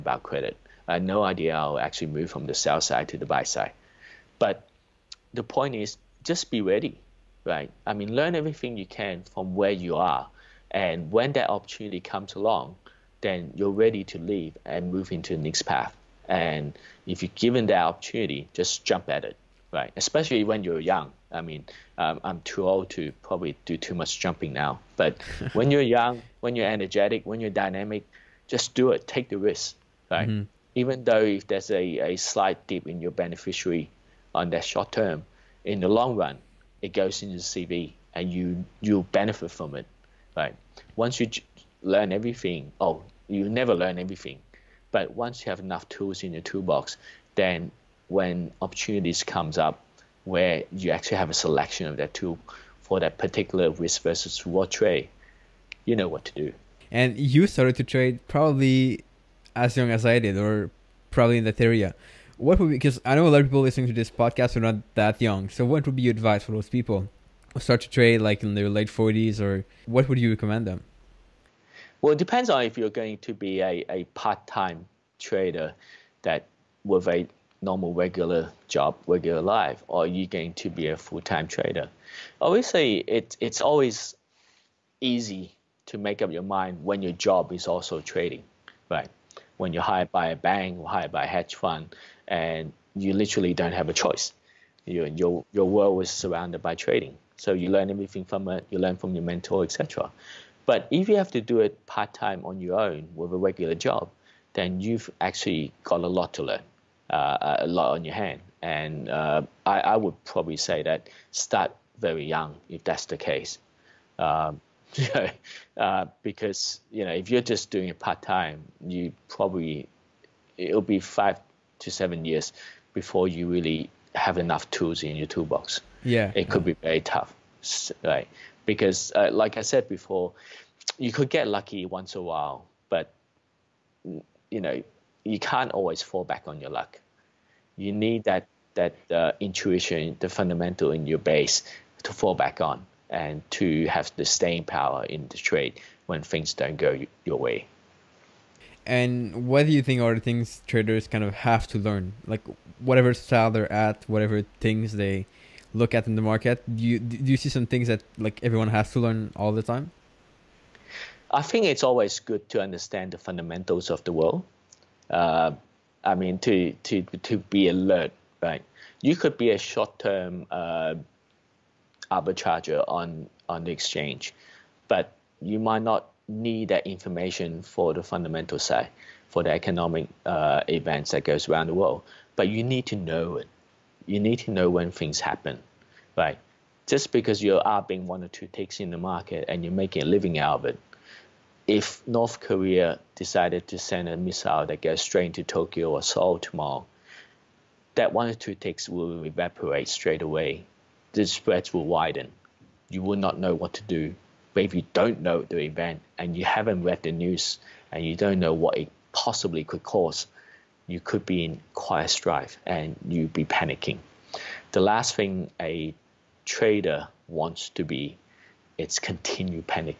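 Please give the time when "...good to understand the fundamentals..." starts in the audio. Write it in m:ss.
2:42.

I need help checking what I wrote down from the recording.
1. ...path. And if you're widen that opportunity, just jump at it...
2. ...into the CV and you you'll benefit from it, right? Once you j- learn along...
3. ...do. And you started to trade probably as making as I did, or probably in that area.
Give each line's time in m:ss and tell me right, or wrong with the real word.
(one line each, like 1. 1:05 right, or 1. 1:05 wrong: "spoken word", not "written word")
1. 0:15 wrong: "given", not "widen"
2. 0:37 wrong: "everything", not "along"
3. 0:56 wrong: "young", not "making".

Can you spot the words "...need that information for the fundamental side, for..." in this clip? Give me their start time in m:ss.
2:56.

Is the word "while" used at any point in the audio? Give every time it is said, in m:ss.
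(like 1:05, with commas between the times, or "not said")
2:12.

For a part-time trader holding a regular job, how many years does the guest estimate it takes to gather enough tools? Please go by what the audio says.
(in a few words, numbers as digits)
5 to 7 years.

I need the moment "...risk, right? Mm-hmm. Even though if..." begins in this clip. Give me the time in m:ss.
0:29.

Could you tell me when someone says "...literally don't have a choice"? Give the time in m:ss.
1:33.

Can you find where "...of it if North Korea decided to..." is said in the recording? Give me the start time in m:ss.
3:10.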